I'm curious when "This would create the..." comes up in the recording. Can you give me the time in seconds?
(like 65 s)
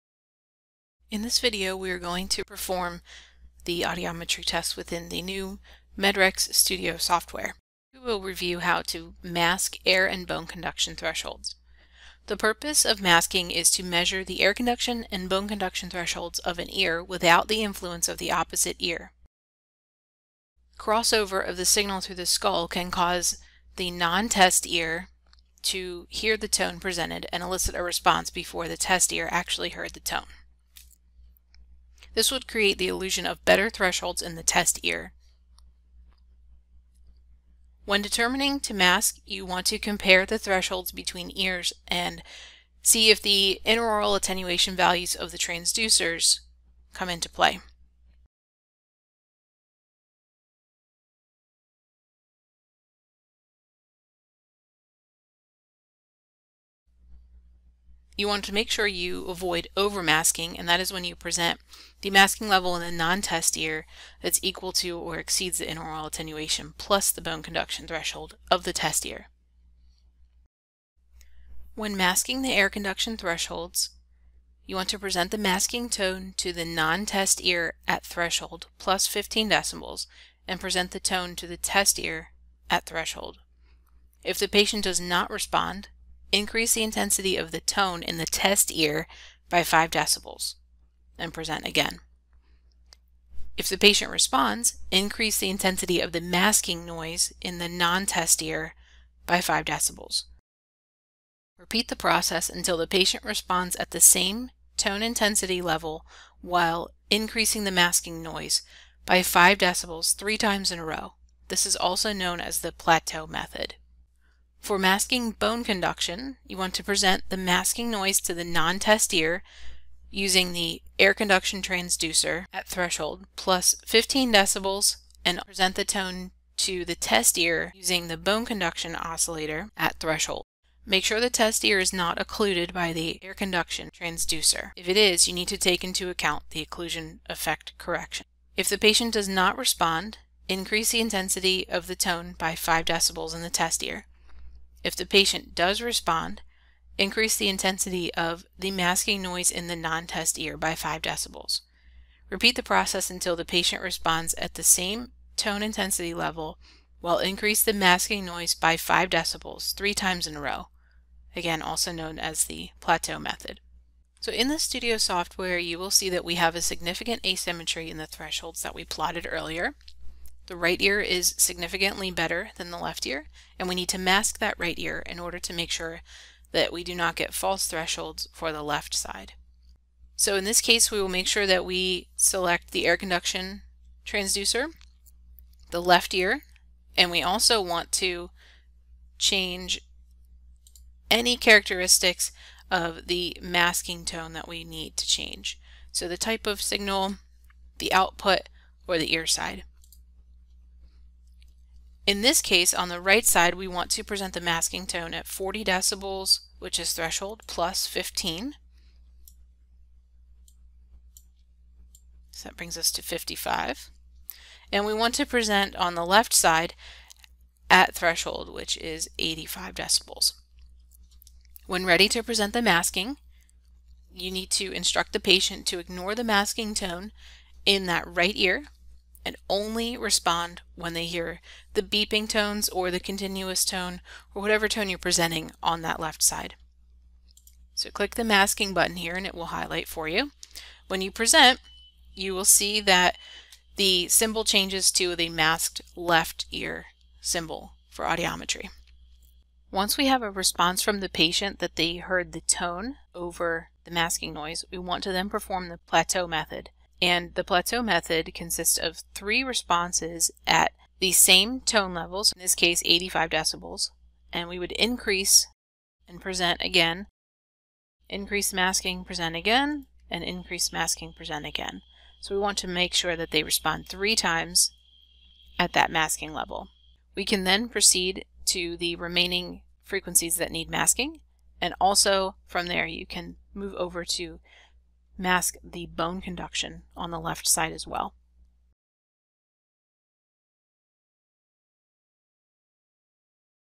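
32 s.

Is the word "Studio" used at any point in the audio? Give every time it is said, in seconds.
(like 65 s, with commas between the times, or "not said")
6 s, 164 s.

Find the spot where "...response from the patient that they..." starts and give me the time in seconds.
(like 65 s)
250 s.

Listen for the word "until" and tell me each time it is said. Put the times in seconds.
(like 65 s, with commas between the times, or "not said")
102 s, 153 s.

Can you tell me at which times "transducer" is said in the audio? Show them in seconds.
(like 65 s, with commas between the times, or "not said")
45 s, 121 s, 133 s, 184 s.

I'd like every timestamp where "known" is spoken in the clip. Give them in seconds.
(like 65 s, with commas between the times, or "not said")
112 s, 161 s.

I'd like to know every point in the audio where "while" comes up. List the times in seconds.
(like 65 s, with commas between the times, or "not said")
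106 s, 156 s.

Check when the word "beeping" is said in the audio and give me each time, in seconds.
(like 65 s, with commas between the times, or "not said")
231 s.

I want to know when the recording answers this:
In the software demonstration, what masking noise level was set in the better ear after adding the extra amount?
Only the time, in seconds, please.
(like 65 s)
213 s.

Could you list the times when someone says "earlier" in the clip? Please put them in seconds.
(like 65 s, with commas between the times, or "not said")
169 s.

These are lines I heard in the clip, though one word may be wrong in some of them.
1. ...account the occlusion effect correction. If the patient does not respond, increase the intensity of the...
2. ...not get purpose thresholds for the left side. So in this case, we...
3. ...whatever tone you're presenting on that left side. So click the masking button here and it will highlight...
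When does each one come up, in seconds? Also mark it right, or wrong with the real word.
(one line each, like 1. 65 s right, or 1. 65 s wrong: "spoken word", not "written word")
1. 136 s right
2. 176 s wrong: "false", not "purpose"
3. 234 s right.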